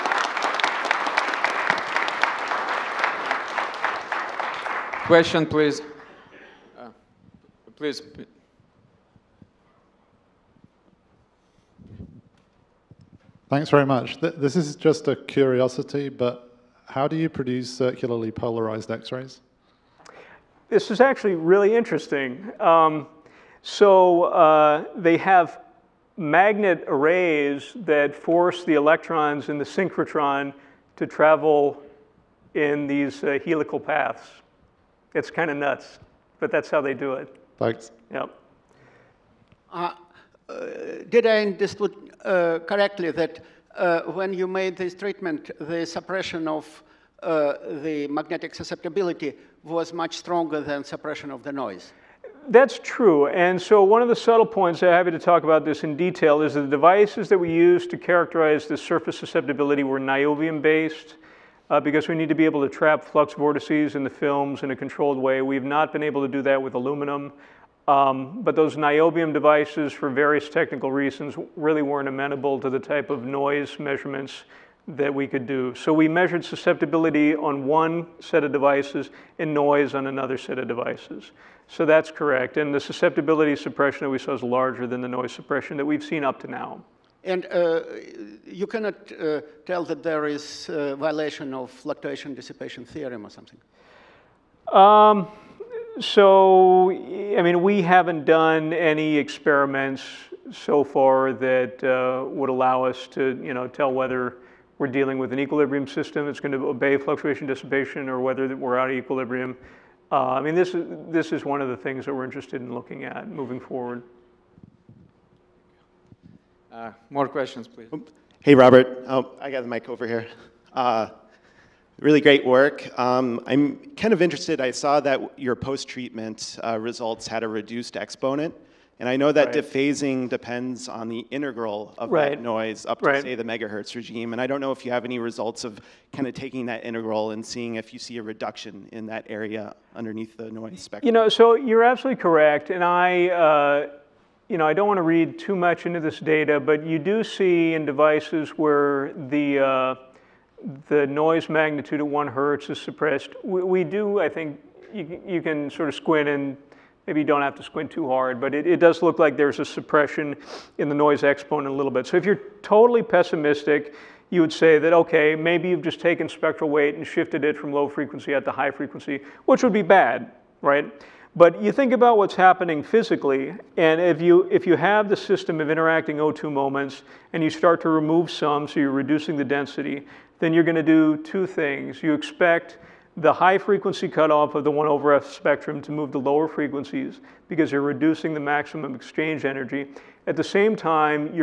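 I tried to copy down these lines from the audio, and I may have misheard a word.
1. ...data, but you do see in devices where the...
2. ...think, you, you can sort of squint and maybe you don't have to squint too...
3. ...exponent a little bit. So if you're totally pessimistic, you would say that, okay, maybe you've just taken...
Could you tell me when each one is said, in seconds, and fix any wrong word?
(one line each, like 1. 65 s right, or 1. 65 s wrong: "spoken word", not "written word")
1. 146 s right
2. 154 s right
3. 161 s right.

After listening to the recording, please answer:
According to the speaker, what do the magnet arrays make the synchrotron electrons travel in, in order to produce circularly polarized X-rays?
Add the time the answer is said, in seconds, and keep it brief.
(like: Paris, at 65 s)
helical paths, at 33 s.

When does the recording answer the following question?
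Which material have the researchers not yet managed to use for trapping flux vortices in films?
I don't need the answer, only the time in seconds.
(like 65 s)
66 s.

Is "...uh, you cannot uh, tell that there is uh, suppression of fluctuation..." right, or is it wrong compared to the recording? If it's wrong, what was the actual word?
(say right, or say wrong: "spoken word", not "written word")
wrong: "violation", not "suppression".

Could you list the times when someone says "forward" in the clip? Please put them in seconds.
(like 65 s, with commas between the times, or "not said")
113 s.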